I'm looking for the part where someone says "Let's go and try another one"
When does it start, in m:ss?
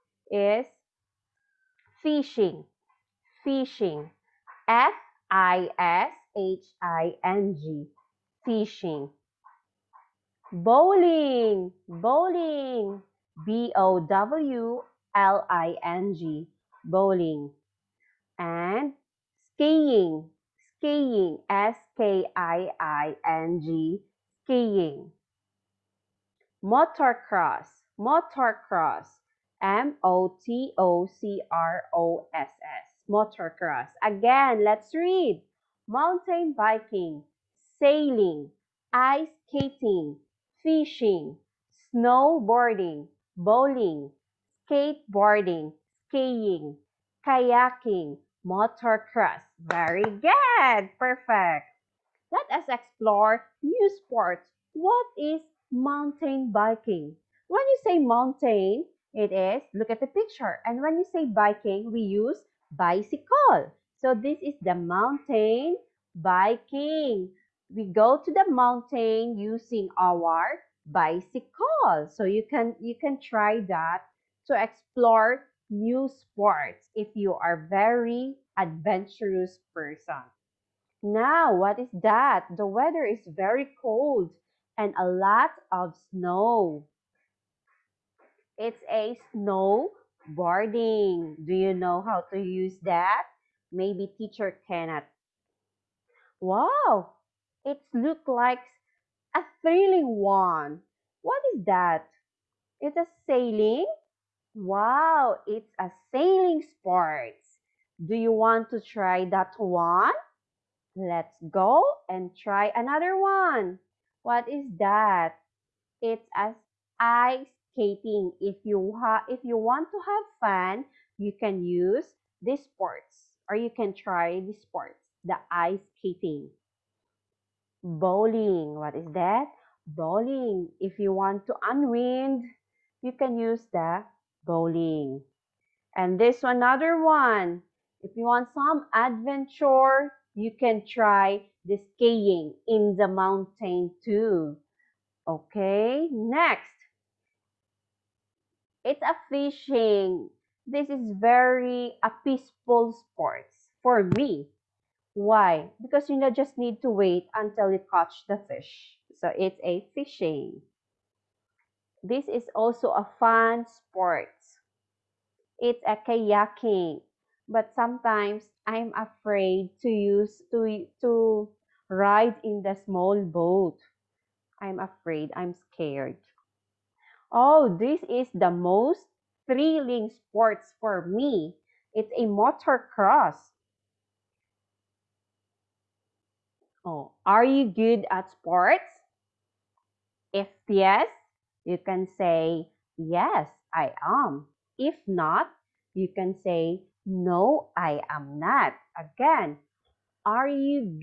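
1:50.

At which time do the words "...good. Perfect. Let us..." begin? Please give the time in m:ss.
0:50.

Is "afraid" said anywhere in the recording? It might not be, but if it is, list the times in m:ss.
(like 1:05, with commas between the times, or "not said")
2:48, 2:54.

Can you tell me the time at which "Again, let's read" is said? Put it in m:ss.
0:34.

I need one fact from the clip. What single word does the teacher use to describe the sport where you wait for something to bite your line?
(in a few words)
peaceful.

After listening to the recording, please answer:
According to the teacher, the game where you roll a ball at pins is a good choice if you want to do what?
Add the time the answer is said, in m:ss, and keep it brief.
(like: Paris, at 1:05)
unwind, at 2:11.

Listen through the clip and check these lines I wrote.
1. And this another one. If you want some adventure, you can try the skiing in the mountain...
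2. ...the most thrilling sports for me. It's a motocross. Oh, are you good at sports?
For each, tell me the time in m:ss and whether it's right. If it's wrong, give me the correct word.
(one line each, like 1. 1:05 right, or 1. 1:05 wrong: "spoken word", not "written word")
1. 2:15 right
2. 2:58 right.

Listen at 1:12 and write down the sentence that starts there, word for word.
So you can you can try that to explore new sports if you are very adventurous person.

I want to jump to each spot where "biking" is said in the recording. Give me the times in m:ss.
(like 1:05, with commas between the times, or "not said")
0:36, 0:56, 1:01, 1:06.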